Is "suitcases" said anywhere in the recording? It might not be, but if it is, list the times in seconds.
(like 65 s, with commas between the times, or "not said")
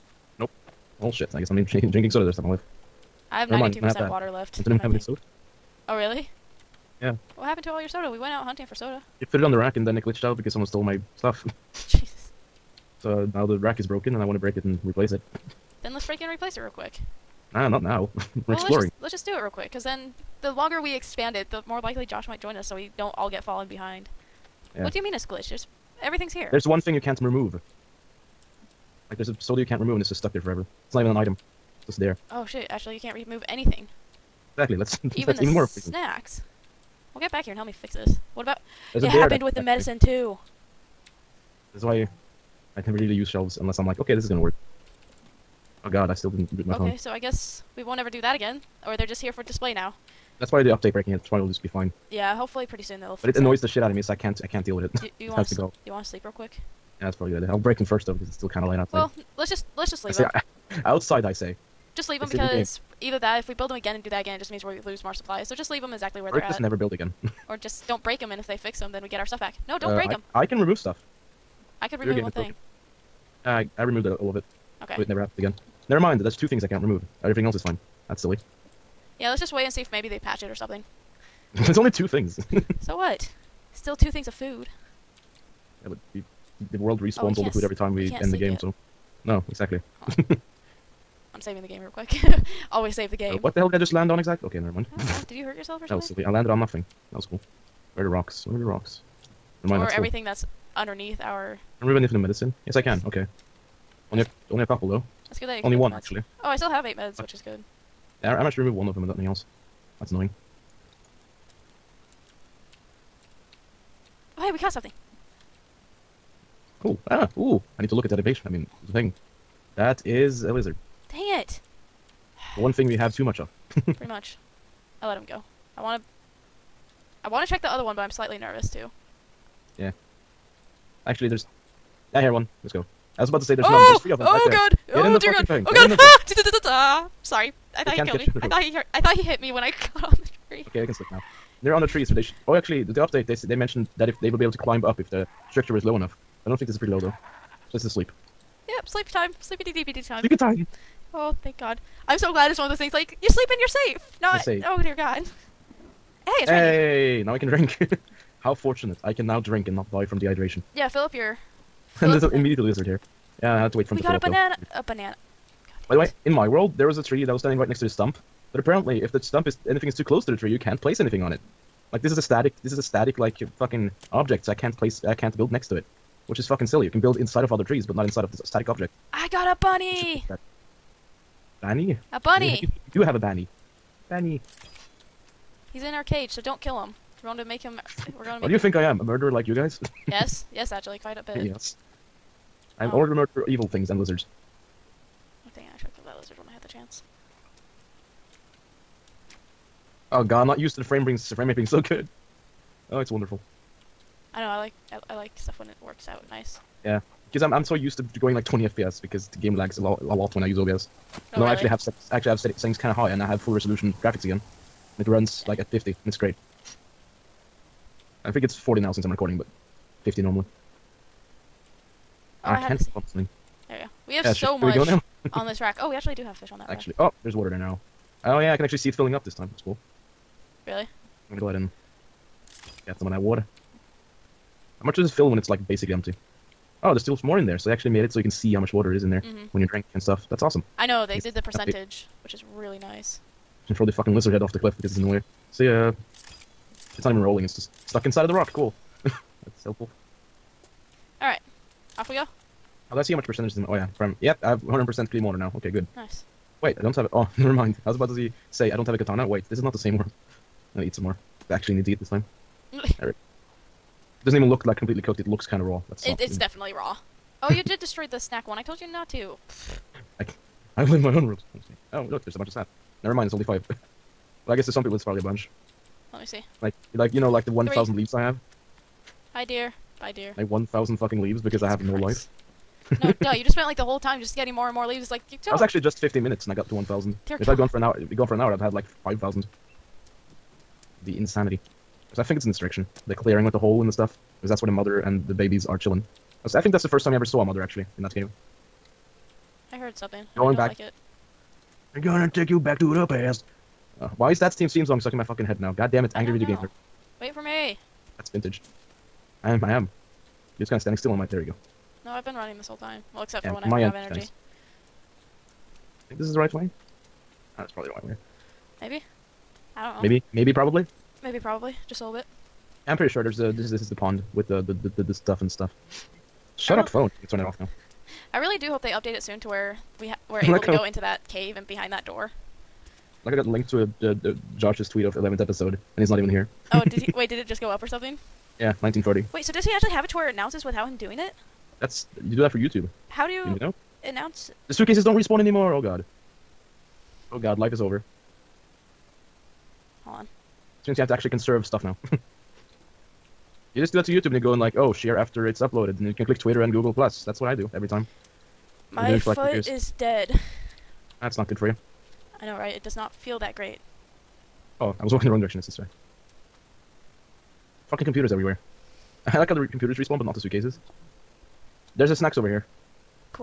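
344 s, 370 s.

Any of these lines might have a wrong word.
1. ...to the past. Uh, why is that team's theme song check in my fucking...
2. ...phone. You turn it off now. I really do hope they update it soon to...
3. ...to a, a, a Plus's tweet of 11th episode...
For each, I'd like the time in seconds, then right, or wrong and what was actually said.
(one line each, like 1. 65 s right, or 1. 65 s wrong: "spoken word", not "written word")
1. 302 s wrong: "stuck", not "check"
2. 326 s right
3. 333 s wrong: "Josh", not "Plus".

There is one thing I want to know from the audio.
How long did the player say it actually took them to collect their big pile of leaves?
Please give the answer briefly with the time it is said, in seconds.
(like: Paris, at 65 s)
15 minutes, at 285 s.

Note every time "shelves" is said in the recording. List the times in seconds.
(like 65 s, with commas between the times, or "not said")
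43 s.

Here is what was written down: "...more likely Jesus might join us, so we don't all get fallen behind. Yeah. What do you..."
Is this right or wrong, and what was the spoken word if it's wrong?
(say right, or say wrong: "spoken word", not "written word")
wrong: "Josh", not "Jesus".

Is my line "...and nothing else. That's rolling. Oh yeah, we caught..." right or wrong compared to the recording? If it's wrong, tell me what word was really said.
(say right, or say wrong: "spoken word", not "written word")
wrong: "annoying", not "rolling".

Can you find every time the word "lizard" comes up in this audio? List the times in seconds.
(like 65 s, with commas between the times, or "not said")
120 s, 162 s, 193 s, 244 s.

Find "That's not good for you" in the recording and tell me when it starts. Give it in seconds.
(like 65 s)
361 s.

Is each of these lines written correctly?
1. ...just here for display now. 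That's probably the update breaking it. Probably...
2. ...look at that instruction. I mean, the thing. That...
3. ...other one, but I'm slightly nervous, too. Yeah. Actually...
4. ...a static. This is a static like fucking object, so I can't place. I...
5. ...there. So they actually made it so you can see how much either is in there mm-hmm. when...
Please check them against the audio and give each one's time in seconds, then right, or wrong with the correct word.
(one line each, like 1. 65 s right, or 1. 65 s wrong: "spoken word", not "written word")
1. 49 s right
2. 117 s wrong: "evasion", not "instruction"
3. 127 s right
4. 172 s right
5. 237 s wrong: "water", not "either".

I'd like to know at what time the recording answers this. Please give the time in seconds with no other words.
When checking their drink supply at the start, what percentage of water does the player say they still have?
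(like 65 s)
3 s.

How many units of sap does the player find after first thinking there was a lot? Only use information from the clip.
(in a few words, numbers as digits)
5.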